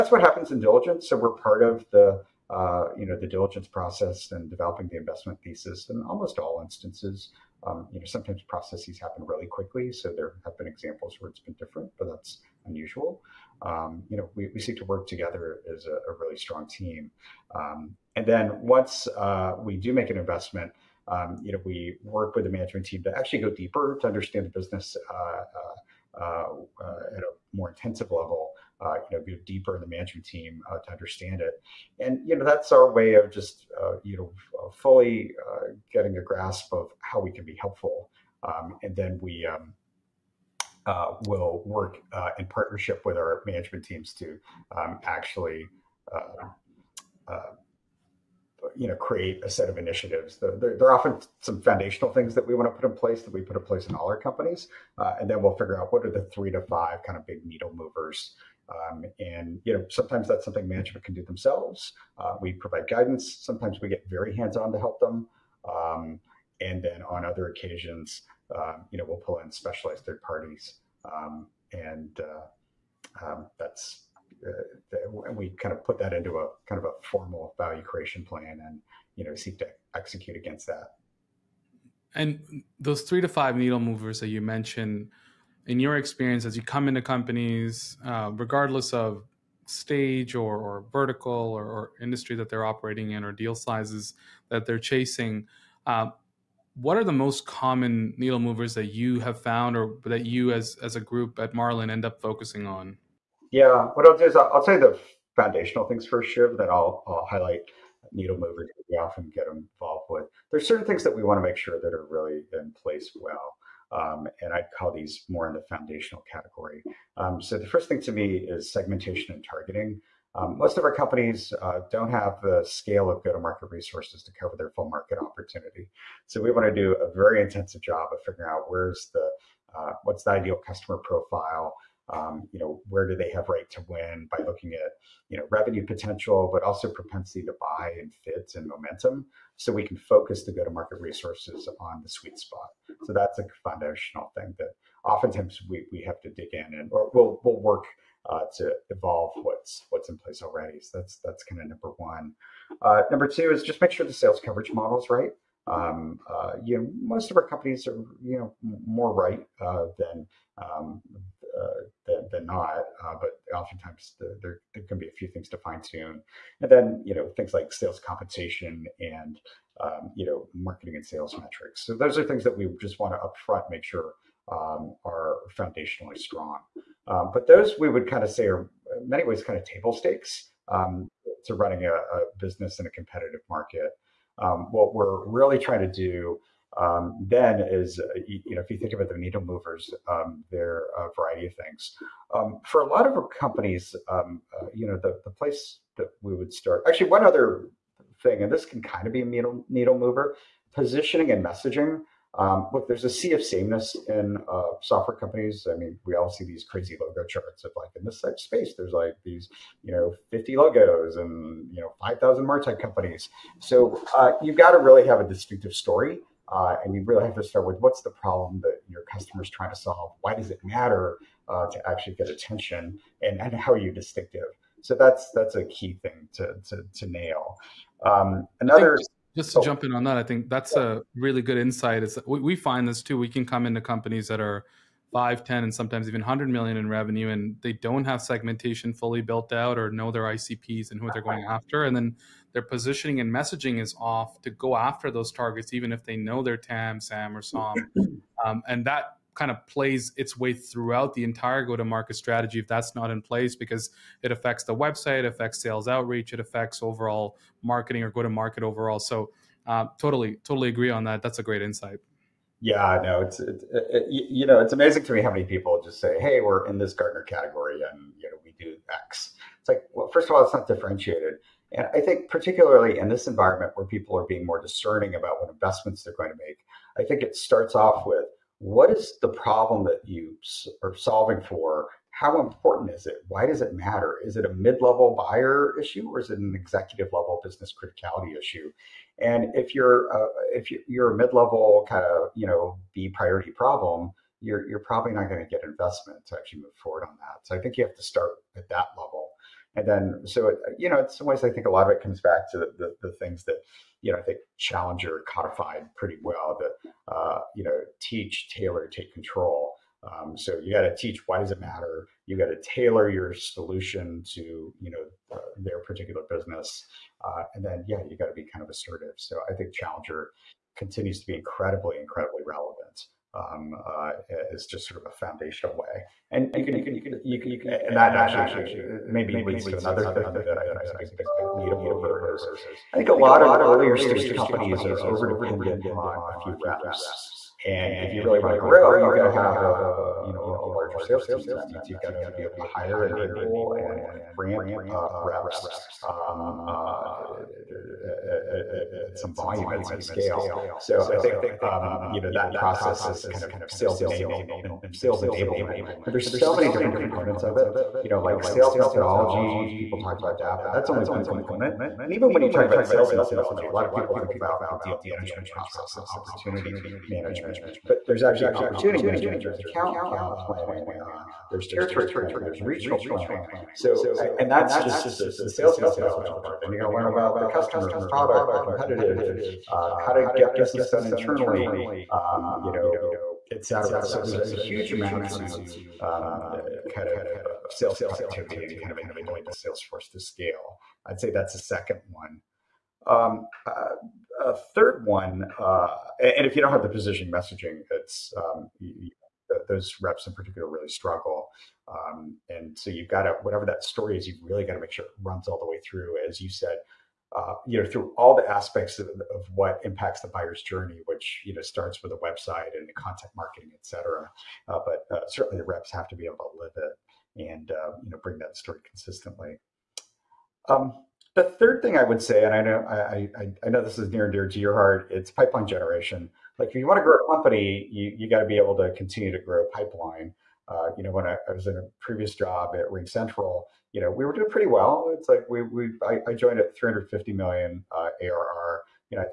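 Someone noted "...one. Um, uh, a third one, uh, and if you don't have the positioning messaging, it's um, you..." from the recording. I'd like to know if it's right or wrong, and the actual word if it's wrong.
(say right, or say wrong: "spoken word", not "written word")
right.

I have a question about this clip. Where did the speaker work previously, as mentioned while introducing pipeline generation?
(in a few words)
RingCentral.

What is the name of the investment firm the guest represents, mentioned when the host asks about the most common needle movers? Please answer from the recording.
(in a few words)
Marlin.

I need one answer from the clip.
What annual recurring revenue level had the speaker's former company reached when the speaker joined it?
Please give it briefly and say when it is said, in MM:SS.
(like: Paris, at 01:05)
$350 million, at 07:16.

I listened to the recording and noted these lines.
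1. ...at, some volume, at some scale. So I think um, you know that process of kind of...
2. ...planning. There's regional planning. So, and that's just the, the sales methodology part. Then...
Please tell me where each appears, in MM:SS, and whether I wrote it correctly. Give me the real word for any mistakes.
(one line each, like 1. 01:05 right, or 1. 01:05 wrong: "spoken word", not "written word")
1. 05:49 right
2. 06:12 right.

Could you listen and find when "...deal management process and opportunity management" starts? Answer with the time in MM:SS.
06:04.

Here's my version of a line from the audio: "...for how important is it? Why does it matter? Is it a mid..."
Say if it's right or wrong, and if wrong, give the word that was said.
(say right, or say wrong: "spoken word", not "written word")
right.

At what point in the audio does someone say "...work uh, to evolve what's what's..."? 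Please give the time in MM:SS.
02:27.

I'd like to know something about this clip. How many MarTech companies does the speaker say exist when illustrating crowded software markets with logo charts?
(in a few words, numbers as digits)
5,000.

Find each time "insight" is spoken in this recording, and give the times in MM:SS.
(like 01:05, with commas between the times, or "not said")
03:51, 04:21.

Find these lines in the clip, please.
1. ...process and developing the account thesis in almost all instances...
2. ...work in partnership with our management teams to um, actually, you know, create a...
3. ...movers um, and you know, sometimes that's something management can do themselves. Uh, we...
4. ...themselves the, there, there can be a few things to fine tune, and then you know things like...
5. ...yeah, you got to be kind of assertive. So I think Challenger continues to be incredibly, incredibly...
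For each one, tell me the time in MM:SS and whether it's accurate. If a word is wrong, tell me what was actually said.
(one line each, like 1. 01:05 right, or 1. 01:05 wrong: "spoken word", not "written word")
1. 00:03 wrong: "investment", not "account"
2. 00:41 right
3. 00:57 right
4. 02:43 wrong: "oftentimes", not "themselves"
5. 05:17 right.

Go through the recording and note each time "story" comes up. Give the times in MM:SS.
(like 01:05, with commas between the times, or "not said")
03:35, 06:43, 06:58.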